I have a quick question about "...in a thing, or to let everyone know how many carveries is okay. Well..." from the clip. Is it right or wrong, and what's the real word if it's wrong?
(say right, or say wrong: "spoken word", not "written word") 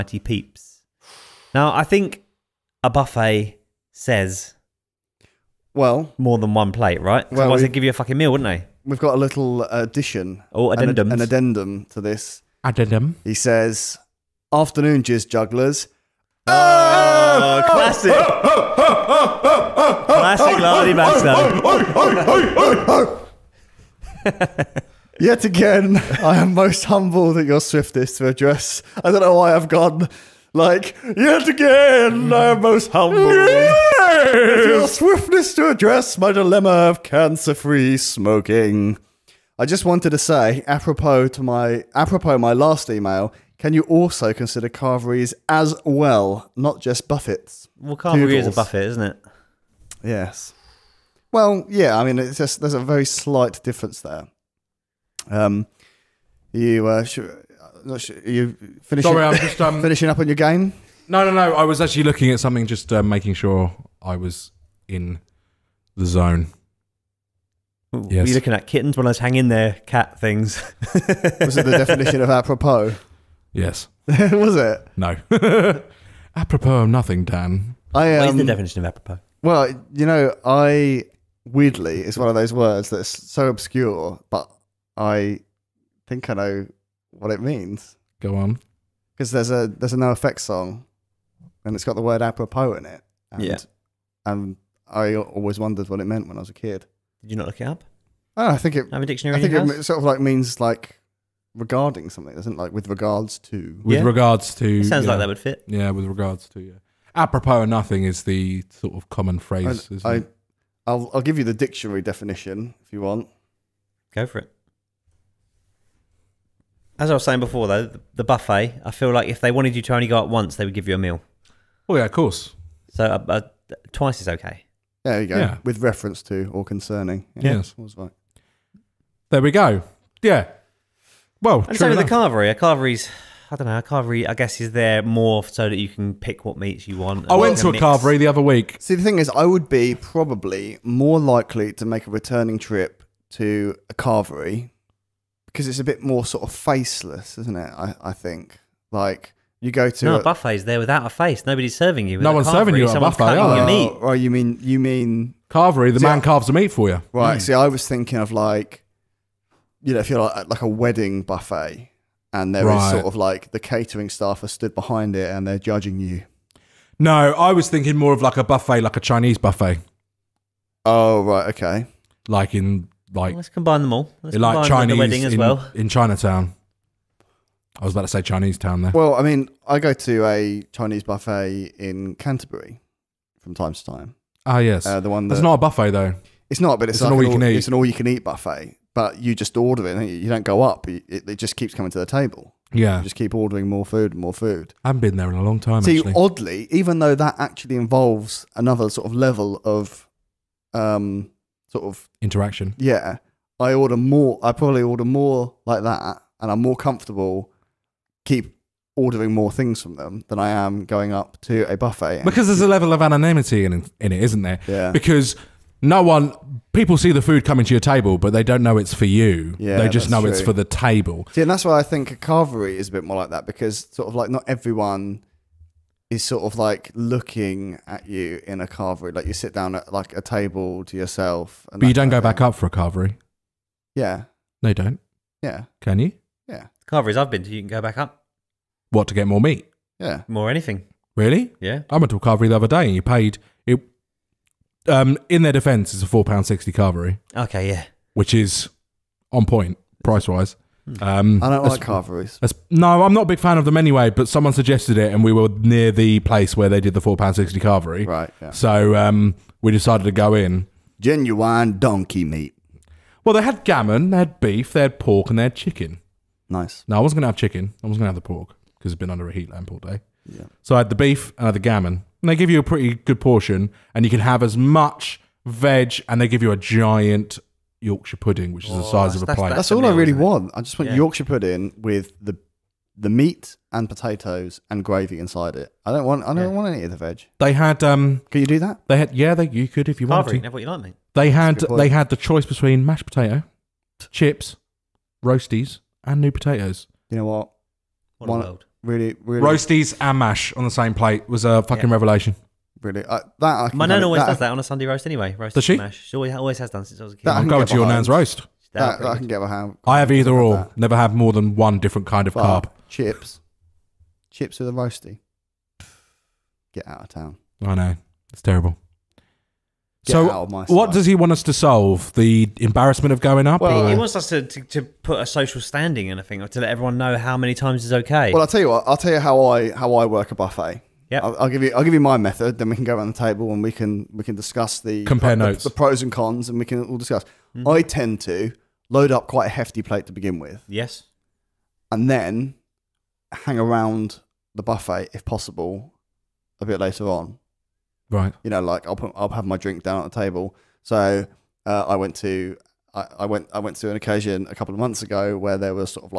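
wrong: "times", not "carveries".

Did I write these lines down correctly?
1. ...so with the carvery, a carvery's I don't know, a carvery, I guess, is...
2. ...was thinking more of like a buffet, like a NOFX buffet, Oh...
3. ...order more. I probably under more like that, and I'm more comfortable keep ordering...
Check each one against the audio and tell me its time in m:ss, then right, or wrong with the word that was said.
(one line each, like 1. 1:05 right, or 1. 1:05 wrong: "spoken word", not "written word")
1. 2:11 right
2. 2:47 wrong: "Chinese", not "NOFX"
3. 3:23 wrong: "order", not "under".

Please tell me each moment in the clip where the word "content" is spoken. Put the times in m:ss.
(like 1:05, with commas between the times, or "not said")
not said.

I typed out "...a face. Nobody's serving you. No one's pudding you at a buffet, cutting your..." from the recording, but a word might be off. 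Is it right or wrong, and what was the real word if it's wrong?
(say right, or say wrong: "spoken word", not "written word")
wrong: "serving", not "pudding".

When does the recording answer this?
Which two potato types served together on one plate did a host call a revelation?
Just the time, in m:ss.
4:59.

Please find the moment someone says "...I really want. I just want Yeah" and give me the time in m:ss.
4:39.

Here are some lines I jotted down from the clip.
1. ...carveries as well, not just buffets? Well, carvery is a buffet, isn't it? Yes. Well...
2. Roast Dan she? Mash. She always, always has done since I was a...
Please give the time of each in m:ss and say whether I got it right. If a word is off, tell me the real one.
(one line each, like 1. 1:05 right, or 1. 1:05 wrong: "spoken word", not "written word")
1. 0:44 right
2. 5:05 wrong: "Does", not "Dan".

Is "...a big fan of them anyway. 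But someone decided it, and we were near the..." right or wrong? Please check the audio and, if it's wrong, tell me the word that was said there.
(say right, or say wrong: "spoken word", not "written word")
wrong: "suggested", not "decided".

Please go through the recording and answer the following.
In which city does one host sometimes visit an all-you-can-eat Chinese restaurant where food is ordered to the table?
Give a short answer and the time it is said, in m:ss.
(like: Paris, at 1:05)
Canterbury, at 3:02.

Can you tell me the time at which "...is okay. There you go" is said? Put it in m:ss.
2:04.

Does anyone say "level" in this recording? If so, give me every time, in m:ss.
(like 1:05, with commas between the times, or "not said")
3:19, 3:32.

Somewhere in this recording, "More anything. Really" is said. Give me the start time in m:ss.
4:00.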